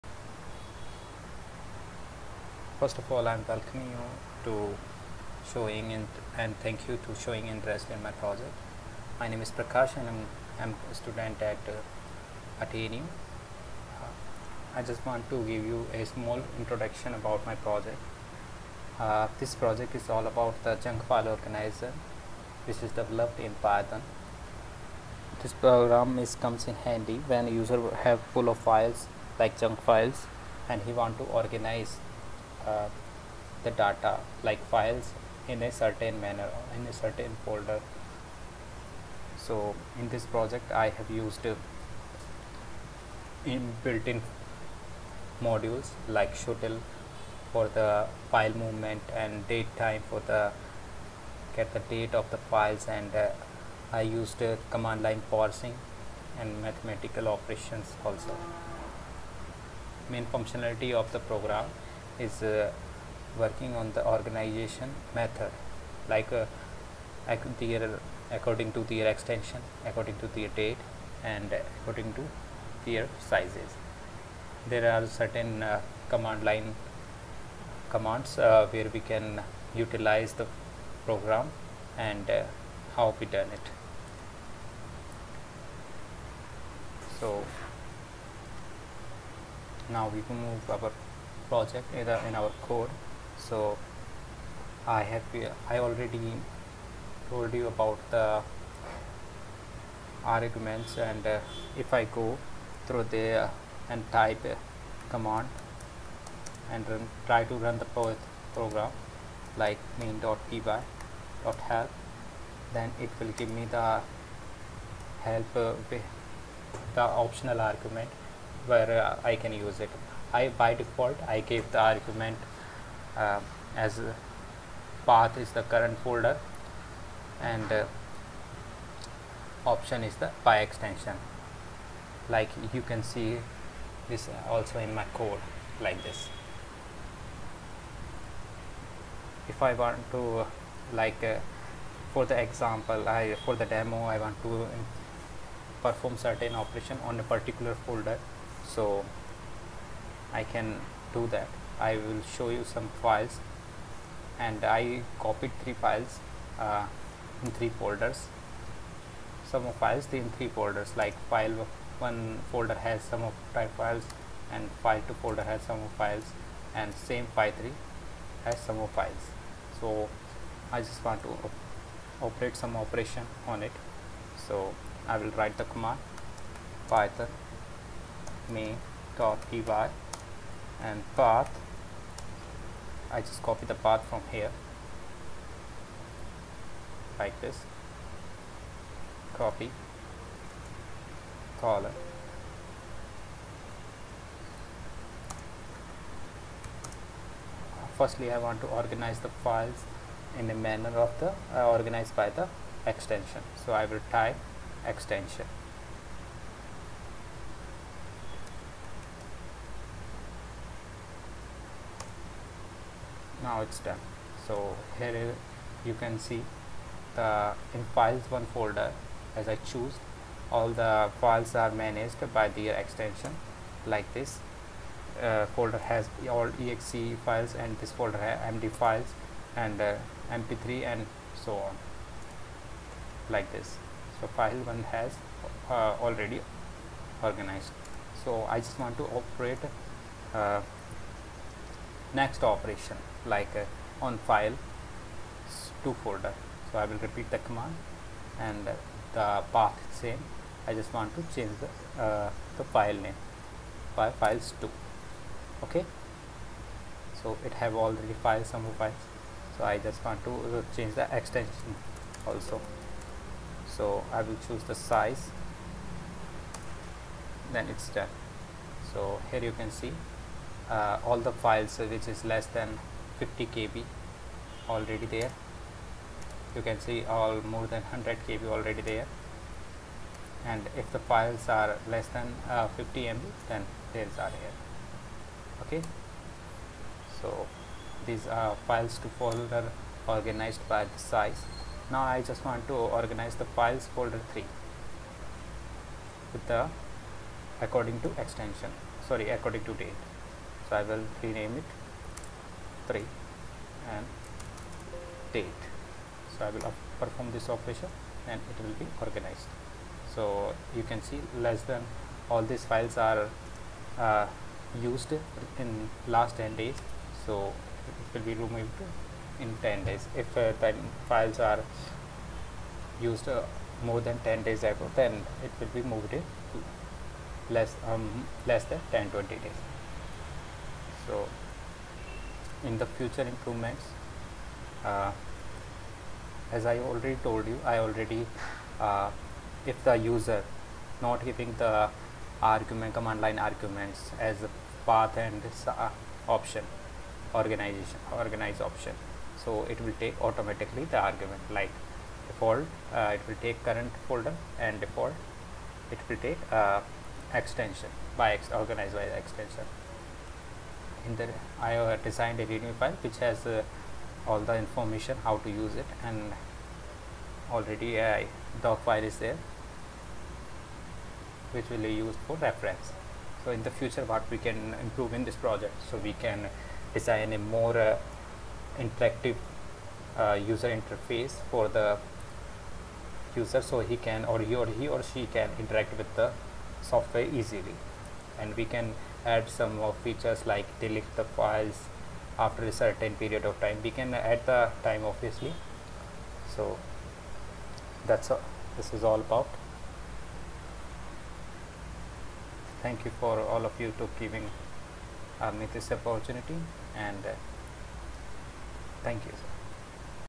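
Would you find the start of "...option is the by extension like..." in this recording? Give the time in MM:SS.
02:09.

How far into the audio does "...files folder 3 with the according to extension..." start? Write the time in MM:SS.
04:53.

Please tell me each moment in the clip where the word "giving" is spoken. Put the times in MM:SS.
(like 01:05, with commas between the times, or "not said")
05:41, 06:44.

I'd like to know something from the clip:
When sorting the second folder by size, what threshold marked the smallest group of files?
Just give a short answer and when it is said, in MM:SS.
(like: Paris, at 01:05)
50 KB, at 04:33.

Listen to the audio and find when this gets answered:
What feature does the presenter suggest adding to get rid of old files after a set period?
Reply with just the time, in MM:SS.
06:30.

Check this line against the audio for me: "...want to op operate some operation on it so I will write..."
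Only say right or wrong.
right.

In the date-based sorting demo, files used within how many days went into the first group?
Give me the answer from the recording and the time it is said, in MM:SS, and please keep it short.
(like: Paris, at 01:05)
10 days, at 05:16.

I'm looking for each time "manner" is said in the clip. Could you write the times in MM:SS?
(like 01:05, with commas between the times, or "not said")
00:36, 03:20.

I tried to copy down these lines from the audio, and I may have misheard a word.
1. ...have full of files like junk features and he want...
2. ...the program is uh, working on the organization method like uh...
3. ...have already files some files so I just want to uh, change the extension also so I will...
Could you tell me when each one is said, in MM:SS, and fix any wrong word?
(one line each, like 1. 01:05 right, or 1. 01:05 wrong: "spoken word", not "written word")
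1. 00:28 wrong: "files", not "features"
2. 01:01 right
3. 04:17 right.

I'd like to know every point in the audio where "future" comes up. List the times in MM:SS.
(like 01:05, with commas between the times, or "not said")
05:32, 06:13.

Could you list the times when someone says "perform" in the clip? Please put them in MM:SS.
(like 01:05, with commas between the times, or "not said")
02:25, 05:06.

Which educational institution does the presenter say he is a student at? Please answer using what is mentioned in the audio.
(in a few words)
AttainU.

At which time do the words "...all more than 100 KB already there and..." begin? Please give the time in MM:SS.
04:37.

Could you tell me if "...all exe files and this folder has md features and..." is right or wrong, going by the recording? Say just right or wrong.
wrong.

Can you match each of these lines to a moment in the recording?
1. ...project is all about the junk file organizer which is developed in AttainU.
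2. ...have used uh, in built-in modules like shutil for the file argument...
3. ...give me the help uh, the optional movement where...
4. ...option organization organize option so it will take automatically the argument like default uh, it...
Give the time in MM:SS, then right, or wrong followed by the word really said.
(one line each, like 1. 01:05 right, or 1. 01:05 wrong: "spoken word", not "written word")
1. 00:19 wrong: "Python", not "AttainU"
2. 00:40 wrong: "movement", not "argument"
3. 01:53 wrong: "argument", not "movement"
4. 05:46 right.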